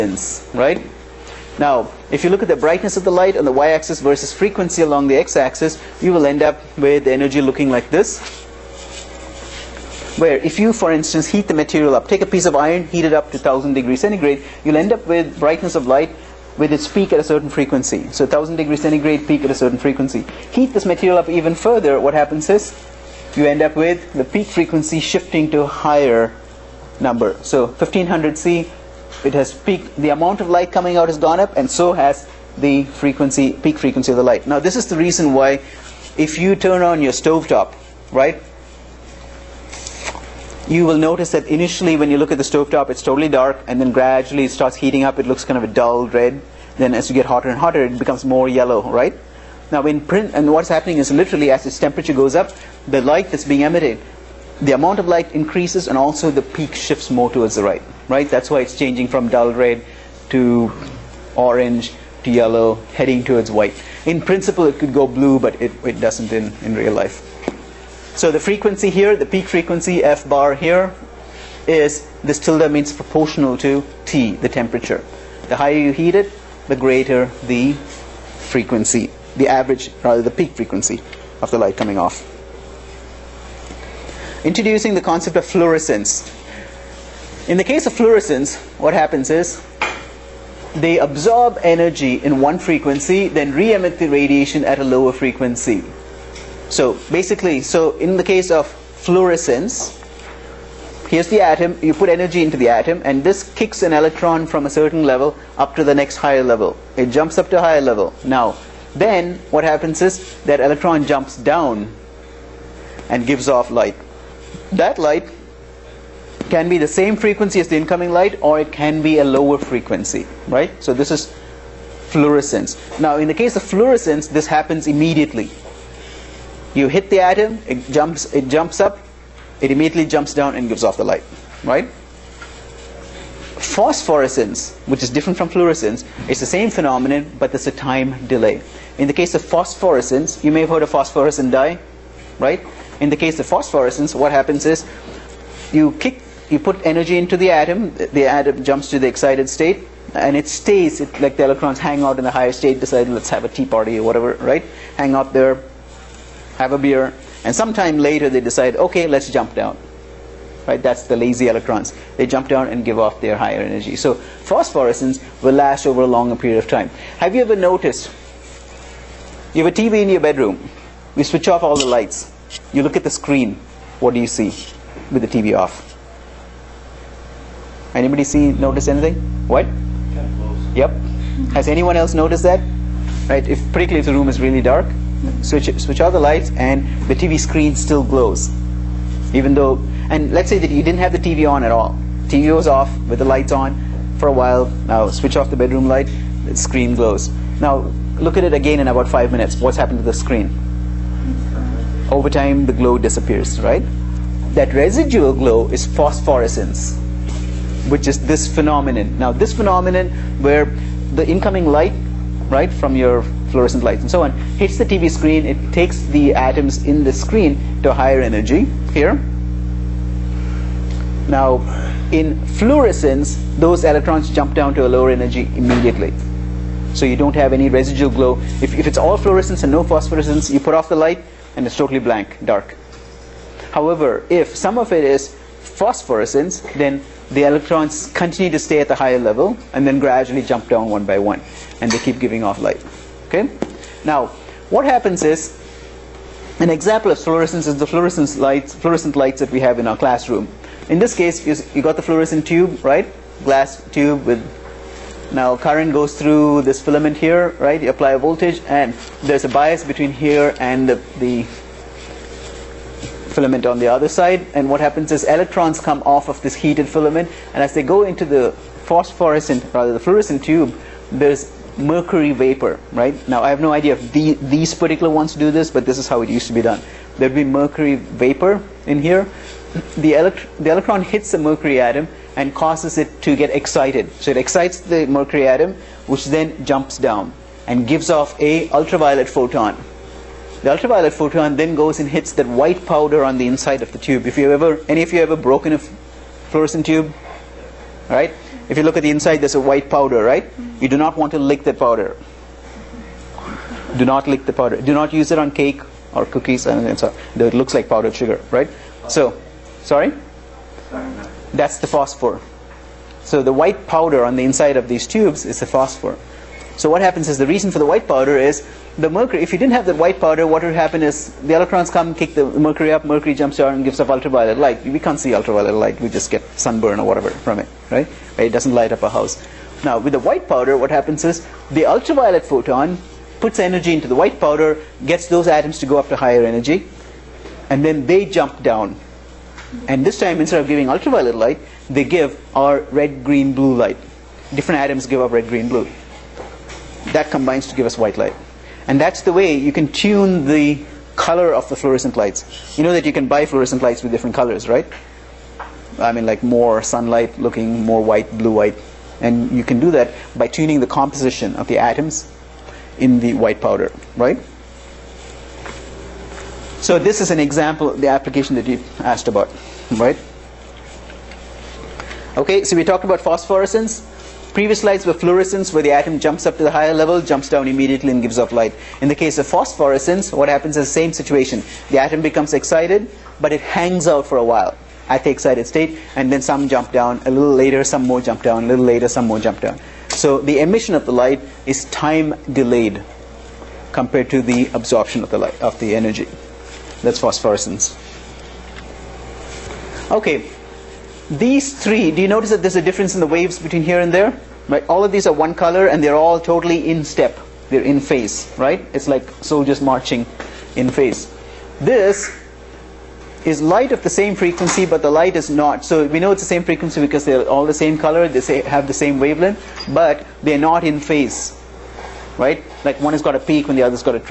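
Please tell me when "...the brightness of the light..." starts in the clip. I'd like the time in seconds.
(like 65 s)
2 s.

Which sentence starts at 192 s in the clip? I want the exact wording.
TV was off with the lights on for a while.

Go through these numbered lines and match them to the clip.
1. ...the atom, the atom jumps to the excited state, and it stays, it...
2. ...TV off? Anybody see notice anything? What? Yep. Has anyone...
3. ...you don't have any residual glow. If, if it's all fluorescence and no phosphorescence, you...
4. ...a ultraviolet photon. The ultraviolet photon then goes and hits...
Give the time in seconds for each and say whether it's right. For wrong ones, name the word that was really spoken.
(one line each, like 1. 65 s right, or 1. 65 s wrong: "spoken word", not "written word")
1. 147 s right
2. 175 s right
3. 227 s right
4. 288 s right.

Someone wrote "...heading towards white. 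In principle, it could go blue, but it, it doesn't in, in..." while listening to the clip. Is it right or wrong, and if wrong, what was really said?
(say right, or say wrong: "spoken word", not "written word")
right.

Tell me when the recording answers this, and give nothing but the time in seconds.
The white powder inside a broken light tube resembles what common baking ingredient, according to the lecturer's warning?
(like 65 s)
307 s.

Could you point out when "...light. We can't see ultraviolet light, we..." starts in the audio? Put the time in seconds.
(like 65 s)
324 s.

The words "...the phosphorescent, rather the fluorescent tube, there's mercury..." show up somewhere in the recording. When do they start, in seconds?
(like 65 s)
268 s.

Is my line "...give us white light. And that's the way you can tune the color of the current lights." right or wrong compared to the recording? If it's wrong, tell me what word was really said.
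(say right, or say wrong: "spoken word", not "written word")
wrong: "fluorescent", not "current".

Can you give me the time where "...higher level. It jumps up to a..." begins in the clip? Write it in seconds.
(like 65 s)
106 s.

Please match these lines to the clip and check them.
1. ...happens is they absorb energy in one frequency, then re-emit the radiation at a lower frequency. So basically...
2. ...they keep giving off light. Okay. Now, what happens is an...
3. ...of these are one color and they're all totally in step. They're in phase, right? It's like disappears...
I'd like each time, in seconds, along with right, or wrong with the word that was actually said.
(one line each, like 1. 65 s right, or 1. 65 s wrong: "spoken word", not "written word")
1. 88 s right
2. 241 s right
3. 405 s wrong: "soldiers", not "disappears".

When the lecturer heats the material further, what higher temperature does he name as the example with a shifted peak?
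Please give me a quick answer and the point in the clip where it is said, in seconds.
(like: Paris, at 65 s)
1500 C, at 27 s.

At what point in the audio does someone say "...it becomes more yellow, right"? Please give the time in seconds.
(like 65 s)
47 s.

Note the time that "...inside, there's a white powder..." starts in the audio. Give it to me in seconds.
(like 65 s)
299 s.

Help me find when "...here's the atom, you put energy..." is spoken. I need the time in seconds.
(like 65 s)
101 s.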